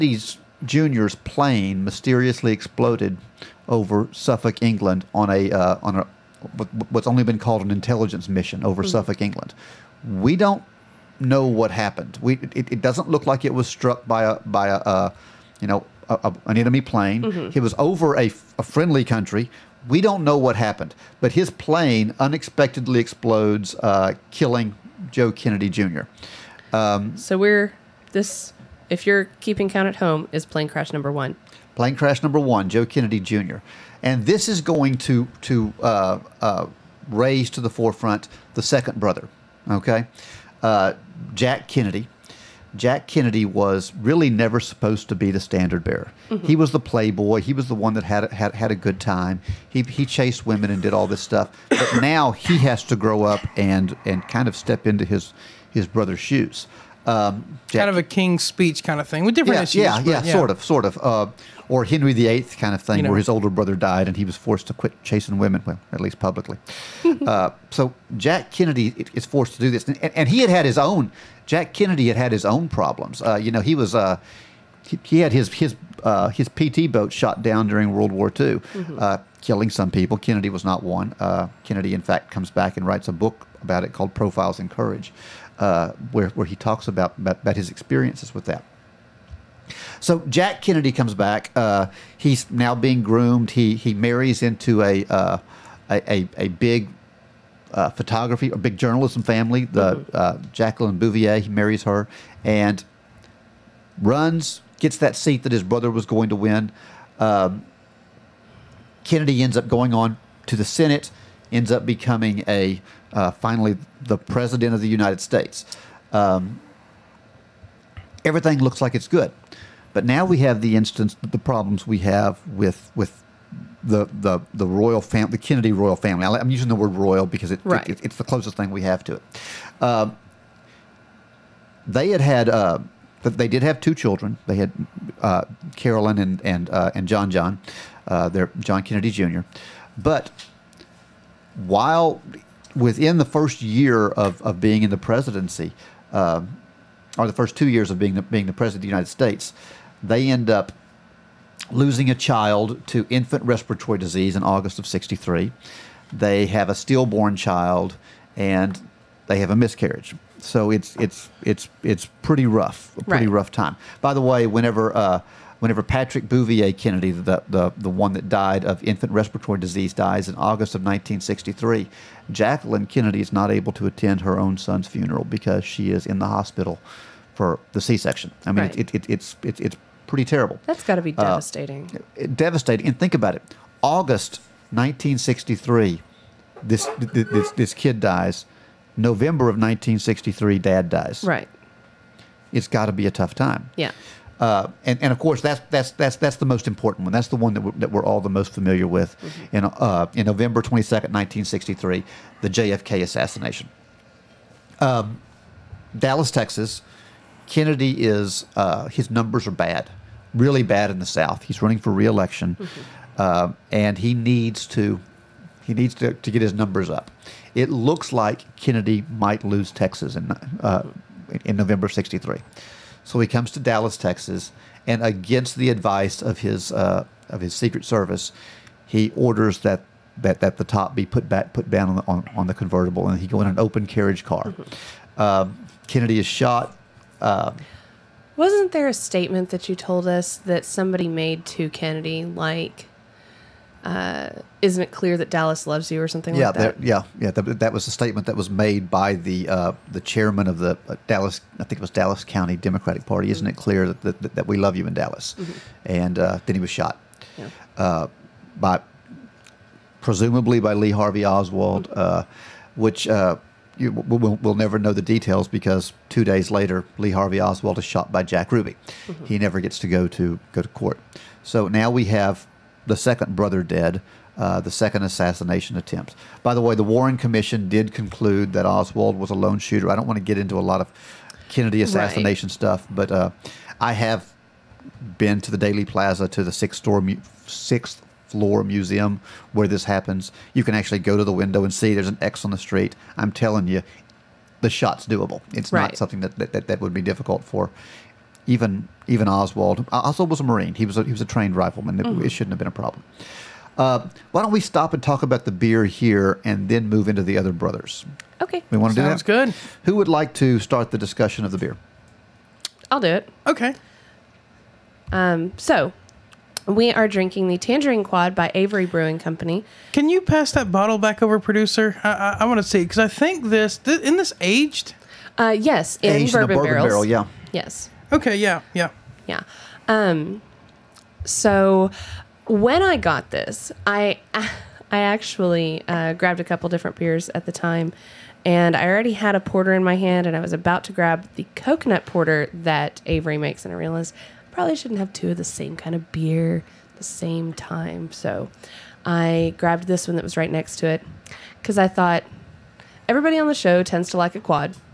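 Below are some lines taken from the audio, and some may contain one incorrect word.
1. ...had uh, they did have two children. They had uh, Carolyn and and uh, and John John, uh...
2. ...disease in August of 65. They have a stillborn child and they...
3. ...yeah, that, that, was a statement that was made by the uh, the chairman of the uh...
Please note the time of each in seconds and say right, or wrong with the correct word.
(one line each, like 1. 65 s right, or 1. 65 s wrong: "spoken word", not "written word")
1. 132 s right
2. 153 s wrong: "63", not "65"
3. 247 s right.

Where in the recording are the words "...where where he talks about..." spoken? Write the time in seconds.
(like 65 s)
85 s.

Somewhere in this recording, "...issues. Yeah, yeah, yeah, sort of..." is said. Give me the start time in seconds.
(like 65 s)
59 s.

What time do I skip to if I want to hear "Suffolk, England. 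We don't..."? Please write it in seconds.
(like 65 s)
8 s.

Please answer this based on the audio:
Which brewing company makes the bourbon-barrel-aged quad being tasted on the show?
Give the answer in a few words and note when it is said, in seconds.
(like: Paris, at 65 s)
Avery Brewing Company, at 318 s.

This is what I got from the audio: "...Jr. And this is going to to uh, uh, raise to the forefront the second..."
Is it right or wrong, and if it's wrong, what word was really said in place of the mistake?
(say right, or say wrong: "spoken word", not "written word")
right.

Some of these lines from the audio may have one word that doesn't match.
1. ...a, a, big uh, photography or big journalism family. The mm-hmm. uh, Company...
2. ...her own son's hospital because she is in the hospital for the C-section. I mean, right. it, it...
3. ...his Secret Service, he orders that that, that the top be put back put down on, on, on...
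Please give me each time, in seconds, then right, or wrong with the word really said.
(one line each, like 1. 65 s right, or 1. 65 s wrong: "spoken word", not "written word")
1. 96 s wrong: "Jacqueline", not "Company"
2. 174 s wrong: "funeral", not "hospital"
3. 227 s right.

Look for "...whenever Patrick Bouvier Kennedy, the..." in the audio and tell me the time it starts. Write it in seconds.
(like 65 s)
165 s.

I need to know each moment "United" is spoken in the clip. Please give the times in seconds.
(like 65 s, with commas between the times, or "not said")
114 s, 148 s.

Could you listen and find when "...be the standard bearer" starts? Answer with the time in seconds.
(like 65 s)
45 s.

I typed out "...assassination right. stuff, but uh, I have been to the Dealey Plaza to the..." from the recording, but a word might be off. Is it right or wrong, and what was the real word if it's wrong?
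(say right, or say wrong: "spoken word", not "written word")
right.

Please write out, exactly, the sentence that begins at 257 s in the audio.
Uh, by presumably by Lee Harvey Oswald, mm-hmm.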